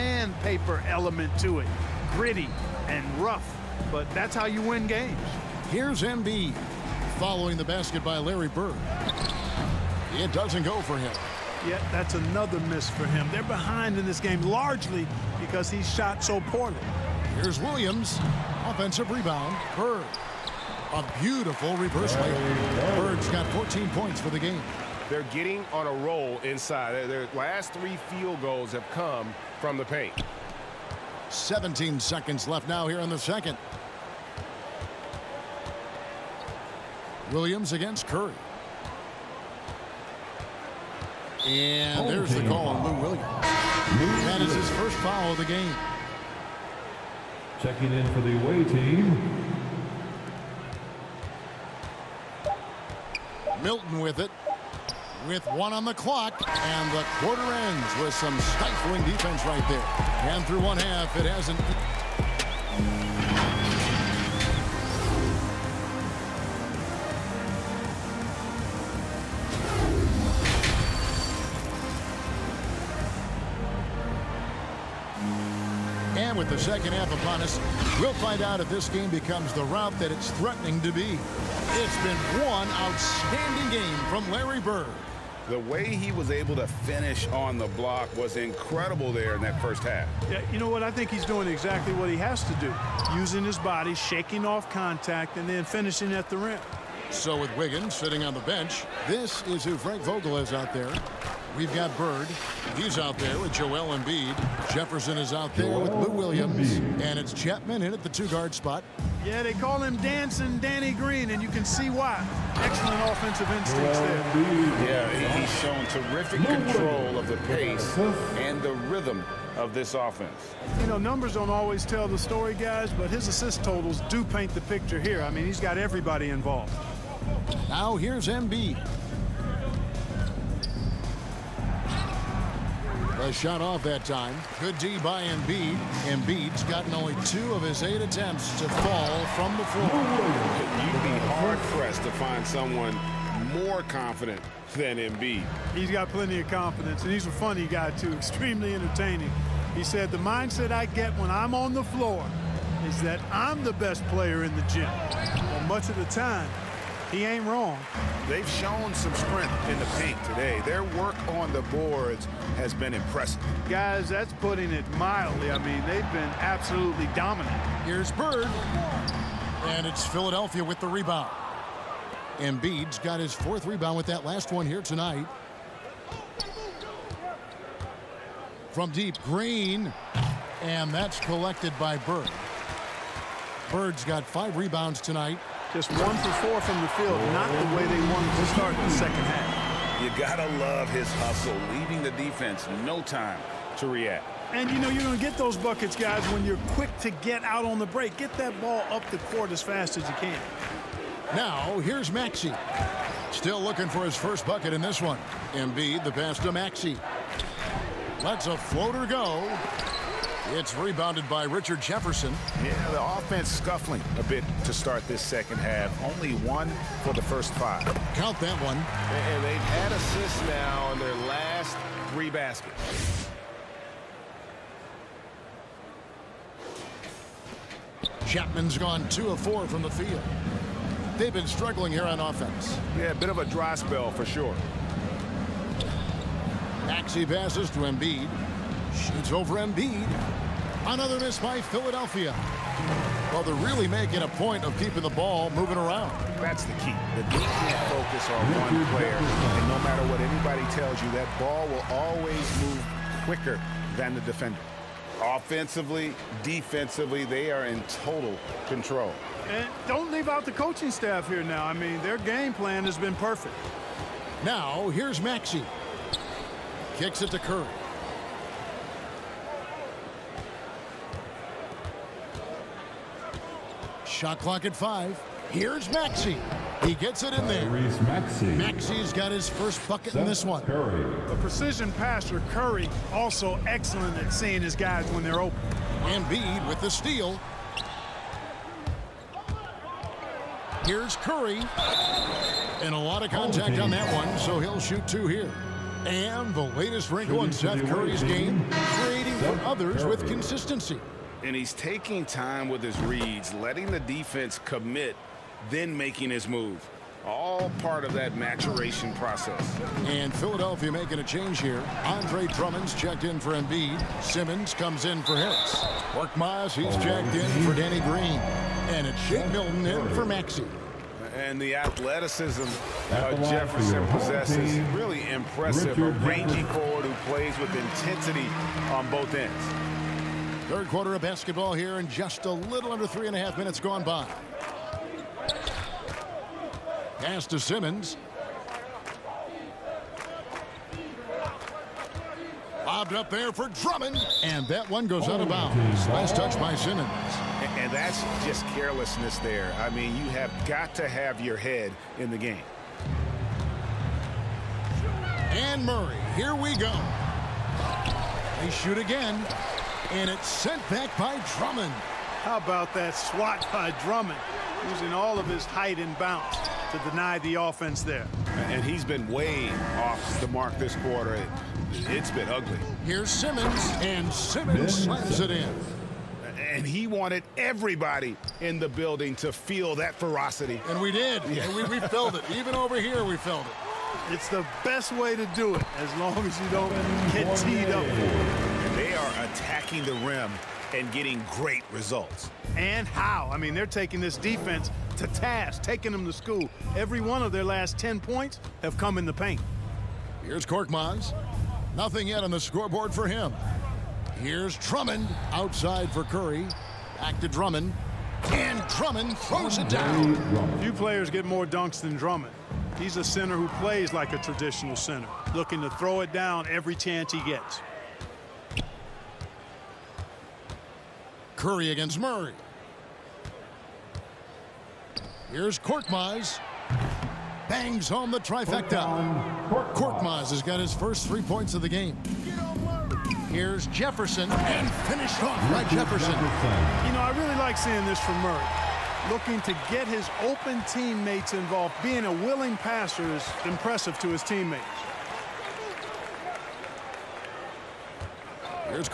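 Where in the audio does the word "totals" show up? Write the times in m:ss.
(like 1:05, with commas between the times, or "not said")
2:03, 4:18.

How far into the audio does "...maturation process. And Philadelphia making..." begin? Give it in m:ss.
5:08.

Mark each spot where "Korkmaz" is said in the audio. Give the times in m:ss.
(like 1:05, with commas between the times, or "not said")
6:40, 7:05, 7:09.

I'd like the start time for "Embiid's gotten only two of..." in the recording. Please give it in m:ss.
2:16.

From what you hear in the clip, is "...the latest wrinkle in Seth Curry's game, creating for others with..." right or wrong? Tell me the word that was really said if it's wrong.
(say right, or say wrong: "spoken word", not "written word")
right.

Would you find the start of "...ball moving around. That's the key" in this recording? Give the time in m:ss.
4:05.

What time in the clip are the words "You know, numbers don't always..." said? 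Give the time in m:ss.
2:00.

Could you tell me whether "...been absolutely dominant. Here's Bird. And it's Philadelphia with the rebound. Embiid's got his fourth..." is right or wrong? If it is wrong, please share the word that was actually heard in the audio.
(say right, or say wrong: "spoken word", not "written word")
right.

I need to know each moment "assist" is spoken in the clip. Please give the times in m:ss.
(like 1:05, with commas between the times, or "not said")
2:03, 3:39.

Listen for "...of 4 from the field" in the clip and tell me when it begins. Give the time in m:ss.
3:49.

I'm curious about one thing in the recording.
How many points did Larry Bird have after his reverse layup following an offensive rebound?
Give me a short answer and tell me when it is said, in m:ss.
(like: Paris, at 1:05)
14, at 0:23.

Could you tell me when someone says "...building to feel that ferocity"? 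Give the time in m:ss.
6:18.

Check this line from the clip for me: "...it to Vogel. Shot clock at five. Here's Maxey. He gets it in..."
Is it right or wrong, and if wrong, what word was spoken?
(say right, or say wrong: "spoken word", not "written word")
wrong: "Curry", not "Vogel".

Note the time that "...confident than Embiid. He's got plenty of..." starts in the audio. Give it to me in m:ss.
2:23.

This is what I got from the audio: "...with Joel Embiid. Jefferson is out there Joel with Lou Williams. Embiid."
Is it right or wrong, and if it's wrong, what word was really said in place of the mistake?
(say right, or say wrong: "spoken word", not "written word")
right.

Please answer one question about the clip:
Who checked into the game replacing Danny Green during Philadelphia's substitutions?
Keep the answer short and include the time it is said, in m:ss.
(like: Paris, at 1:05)
Mark Myers, at 5:16.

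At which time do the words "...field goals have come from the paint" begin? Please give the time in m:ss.
0:28.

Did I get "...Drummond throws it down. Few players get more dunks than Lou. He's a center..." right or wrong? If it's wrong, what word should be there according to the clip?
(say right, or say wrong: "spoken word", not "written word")
wrong: "Drummond", not "Lou".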